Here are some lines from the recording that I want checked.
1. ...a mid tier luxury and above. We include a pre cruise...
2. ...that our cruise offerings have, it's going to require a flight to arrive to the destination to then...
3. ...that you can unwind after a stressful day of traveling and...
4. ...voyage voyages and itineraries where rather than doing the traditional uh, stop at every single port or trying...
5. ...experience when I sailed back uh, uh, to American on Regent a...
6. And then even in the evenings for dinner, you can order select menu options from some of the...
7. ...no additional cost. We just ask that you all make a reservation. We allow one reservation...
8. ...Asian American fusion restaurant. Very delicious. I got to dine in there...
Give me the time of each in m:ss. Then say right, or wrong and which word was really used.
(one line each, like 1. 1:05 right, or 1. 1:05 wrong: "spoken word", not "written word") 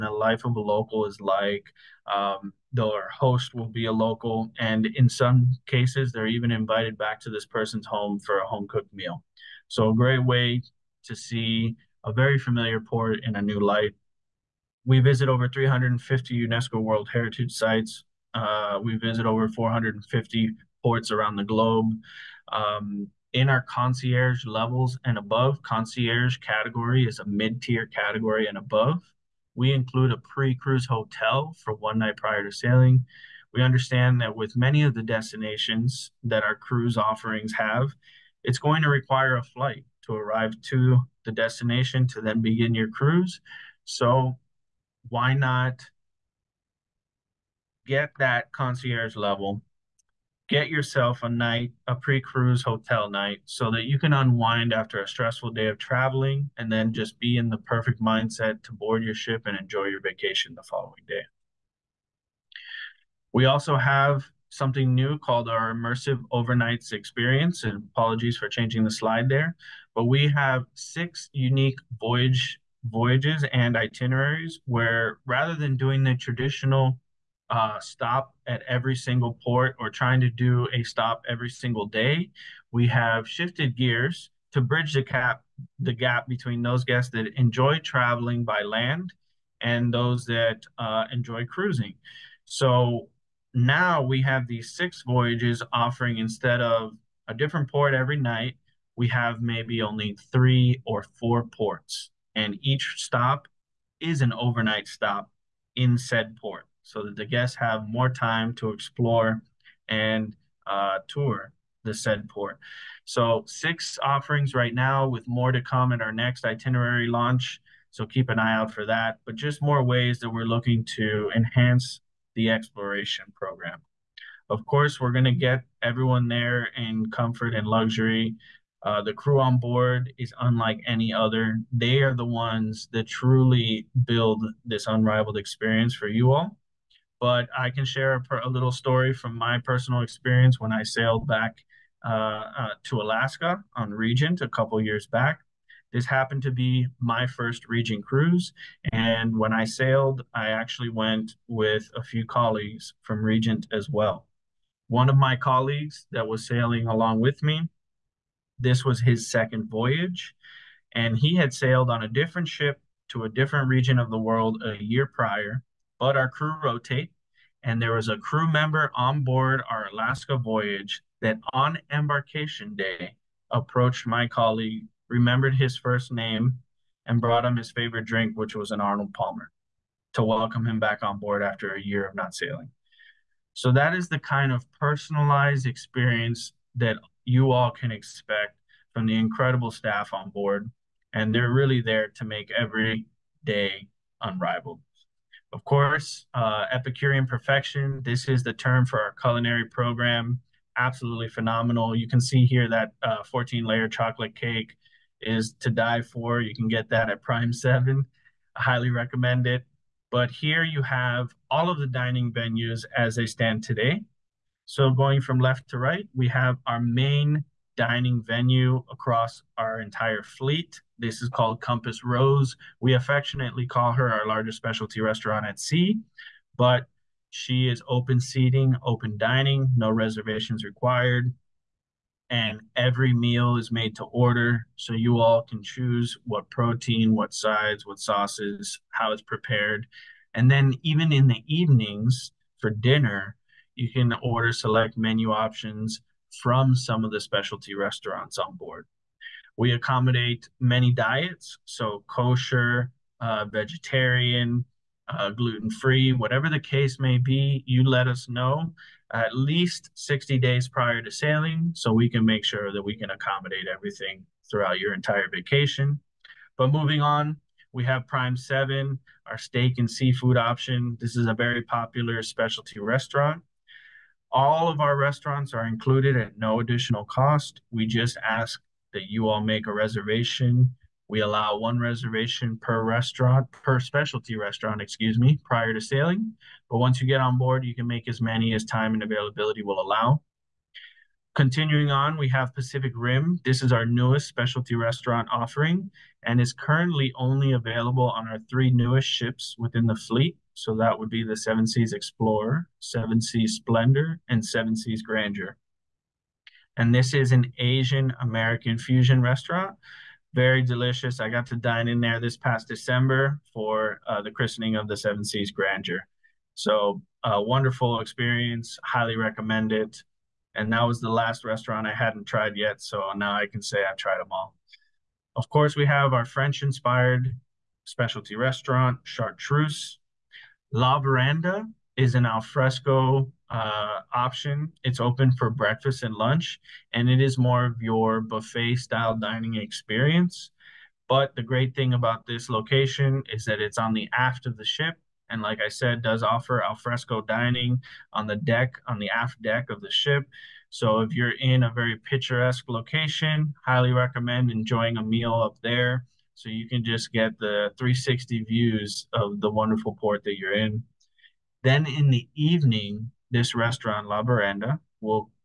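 1. 0:27 wrong: "category", not "luxury"
2. 0:36 right
3. 0:53 right
4. 1:11 right
5. 2:20 wrong: "Alaska", not "American"
6. 4:00 right
7. 4:36 right
8. 5:07 right.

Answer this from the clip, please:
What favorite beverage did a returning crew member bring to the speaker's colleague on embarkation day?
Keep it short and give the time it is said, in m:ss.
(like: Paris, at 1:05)
Arnold Palmer, at 2:58.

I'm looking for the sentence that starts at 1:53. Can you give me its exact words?
So six offerings right now with more to come in our next itinerary launch.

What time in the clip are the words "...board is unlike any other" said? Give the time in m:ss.
2:09.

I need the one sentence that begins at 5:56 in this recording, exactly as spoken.
So you can just get the 360 views of the wonderful port that you're in.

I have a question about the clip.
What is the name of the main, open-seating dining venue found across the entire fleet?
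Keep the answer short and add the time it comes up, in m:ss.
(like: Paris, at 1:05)
Compass Rose, at 3:41.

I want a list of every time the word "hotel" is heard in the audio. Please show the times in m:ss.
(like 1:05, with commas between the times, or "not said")
0:30, 0:52.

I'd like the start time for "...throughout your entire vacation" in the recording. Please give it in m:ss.
4:24.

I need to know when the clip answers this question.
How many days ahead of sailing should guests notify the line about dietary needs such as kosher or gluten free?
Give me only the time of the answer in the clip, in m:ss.
4:19.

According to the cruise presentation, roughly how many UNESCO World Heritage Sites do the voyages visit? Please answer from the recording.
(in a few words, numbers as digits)
Over 350.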